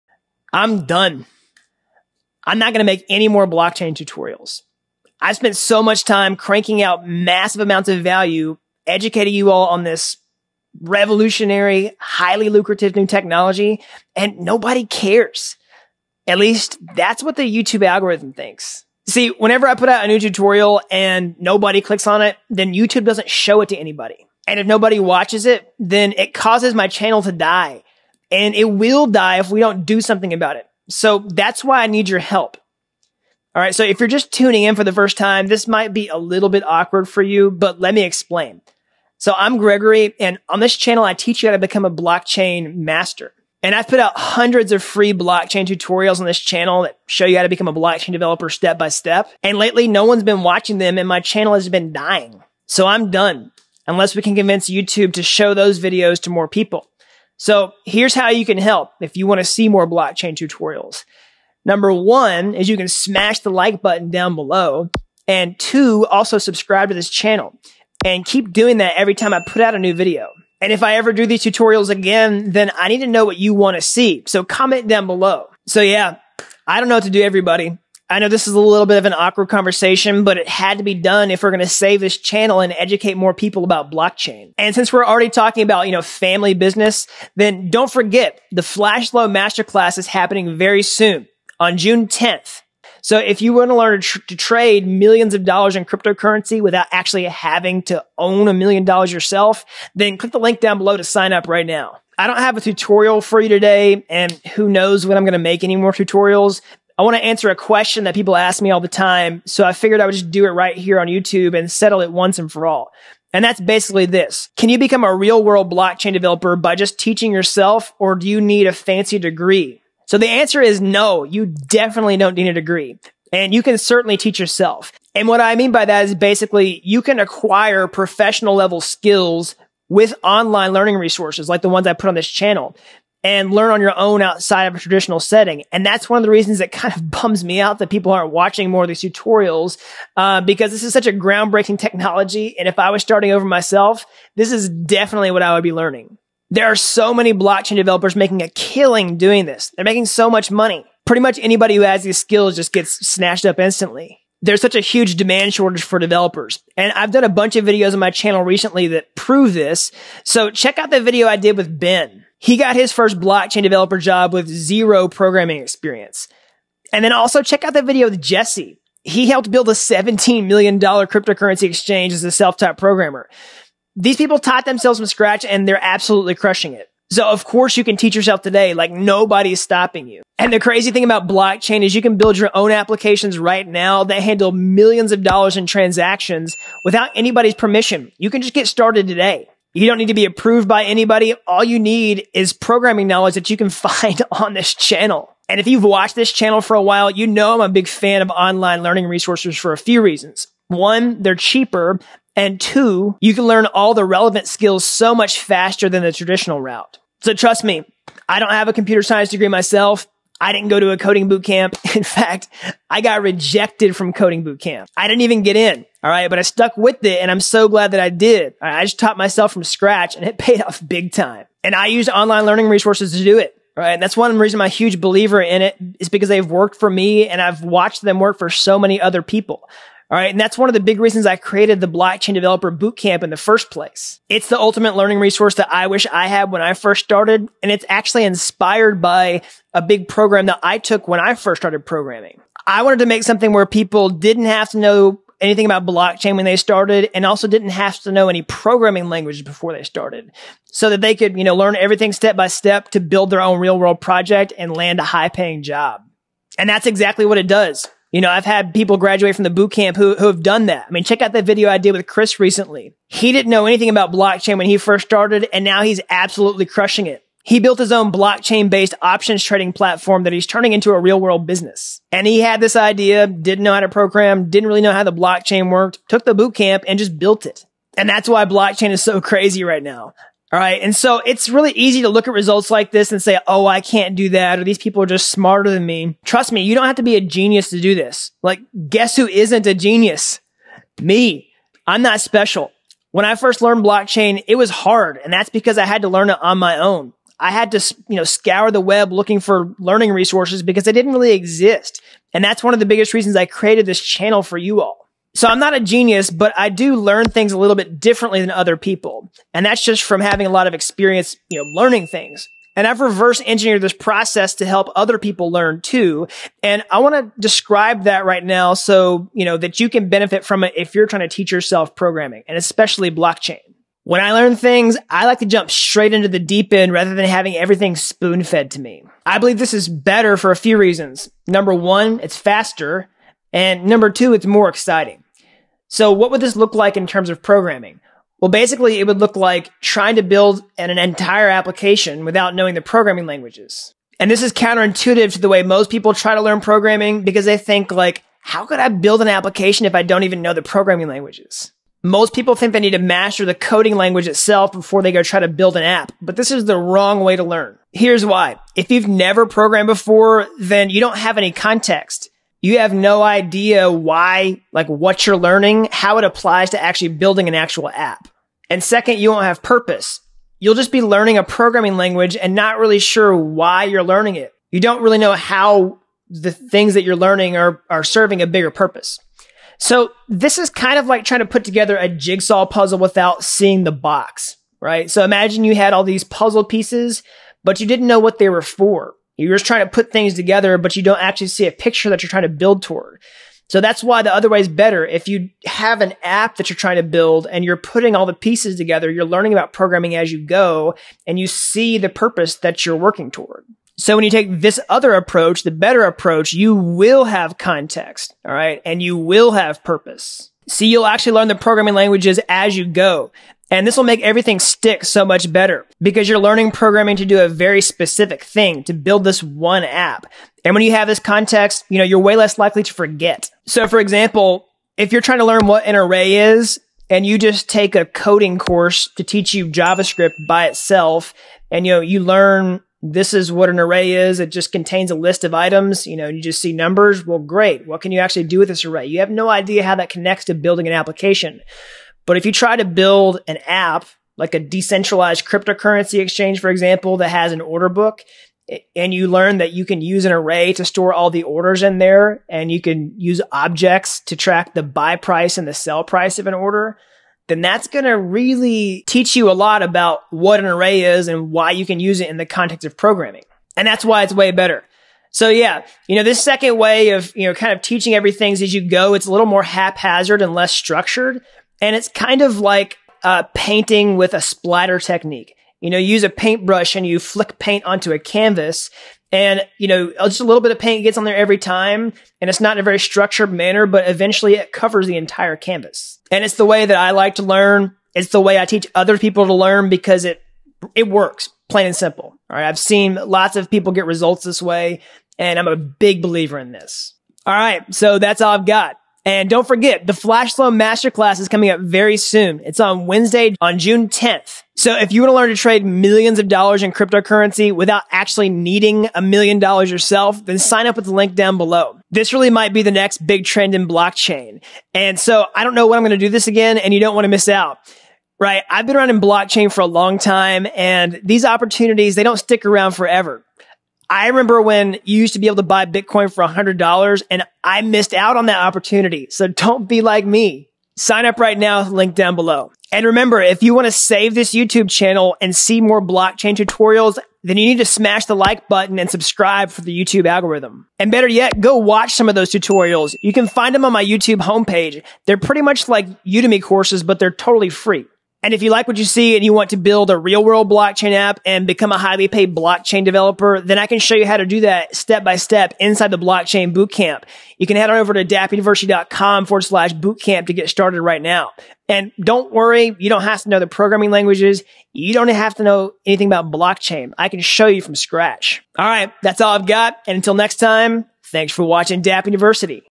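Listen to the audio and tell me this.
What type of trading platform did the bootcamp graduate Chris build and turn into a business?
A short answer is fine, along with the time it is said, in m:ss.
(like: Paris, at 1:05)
options trading platform, at 4:29.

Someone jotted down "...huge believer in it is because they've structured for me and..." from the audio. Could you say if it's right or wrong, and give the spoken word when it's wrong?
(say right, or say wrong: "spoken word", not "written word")
wrong: "worked", not "structured".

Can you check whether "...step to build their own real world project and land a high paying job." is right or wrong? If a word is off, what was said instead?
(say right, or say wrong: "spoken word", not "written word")
right.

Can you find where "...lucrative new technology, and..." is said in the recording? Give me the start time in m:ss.
0:12.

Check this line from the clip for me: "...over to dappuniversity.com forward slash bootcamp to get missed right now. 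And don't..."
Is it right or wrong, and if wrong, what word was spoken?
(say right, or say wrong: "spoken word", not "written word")
wrong: "started", not "missed".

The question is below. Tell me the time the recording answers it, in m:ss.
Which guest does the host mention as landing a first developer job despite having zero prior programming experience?
2:41.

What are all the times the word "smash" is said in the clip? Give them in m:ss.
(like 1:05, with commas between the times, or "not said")
1:02, 8:57.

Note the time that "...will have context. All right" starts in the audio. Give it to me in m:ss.
6:46.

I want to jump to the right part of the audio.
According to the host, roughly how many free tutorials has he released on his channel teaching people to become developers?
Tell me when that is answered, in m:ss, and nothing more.
0:44.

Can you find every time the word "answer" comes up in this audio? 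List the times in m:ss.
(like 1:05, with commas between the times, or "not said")
1:47, 2:00.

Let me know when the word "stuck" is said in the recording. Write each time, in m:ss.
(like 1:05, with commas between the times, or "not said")
3:36.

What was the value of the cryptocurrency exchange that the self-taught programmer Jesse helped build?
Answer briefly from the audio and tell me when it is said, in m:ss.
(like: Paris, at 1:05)
$17 million, at 2:49.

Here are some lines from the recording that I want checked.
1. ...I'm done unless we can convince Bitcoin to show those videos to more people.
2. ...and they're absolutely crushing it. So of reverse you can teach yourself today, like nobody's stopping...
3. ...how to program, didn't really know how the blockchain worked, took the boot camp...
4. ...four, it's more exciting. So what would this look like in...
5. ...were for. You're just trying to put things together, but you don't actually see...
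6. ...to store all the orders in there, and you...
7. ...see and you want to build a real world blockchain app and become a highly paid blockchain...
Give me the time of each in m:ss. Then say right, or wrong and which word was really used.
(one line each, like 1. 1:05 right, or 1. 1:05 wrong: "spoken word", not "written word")
1. 0:52 wrong: "YouTube", not "Bitcoin"
2. 2:55 wrong: "course", not "reverse"
3. 4:33 right
4. 5:34 wrong: "two", not "four"
5. 6:28 right
6. 7:30 right
7. 9:09 right.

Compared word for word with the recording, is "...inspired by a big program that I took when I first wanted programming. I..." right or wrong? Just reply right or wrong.
wrong.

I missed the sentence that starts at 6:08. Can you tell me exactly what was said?
And second, you won't have purpose.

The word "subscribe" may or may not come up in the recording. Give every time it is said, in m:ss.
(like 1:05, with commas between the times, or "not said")
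1:06, 8:59.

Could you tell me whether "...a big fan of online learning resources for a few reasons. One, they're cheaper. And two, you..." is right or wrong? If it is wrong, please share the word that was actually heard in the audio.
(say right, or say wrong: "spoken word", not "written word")
right.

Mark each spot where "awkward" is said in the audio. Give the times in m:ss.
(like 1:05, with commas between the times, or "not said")
0:36, 1:19.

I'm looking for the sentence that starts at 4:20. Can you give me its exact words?
I mean, check out that video I did with Chris recently.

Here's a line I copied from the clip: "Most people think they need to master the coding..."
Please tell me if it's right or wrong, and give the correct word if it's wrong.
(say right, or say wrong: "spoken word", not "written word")
right.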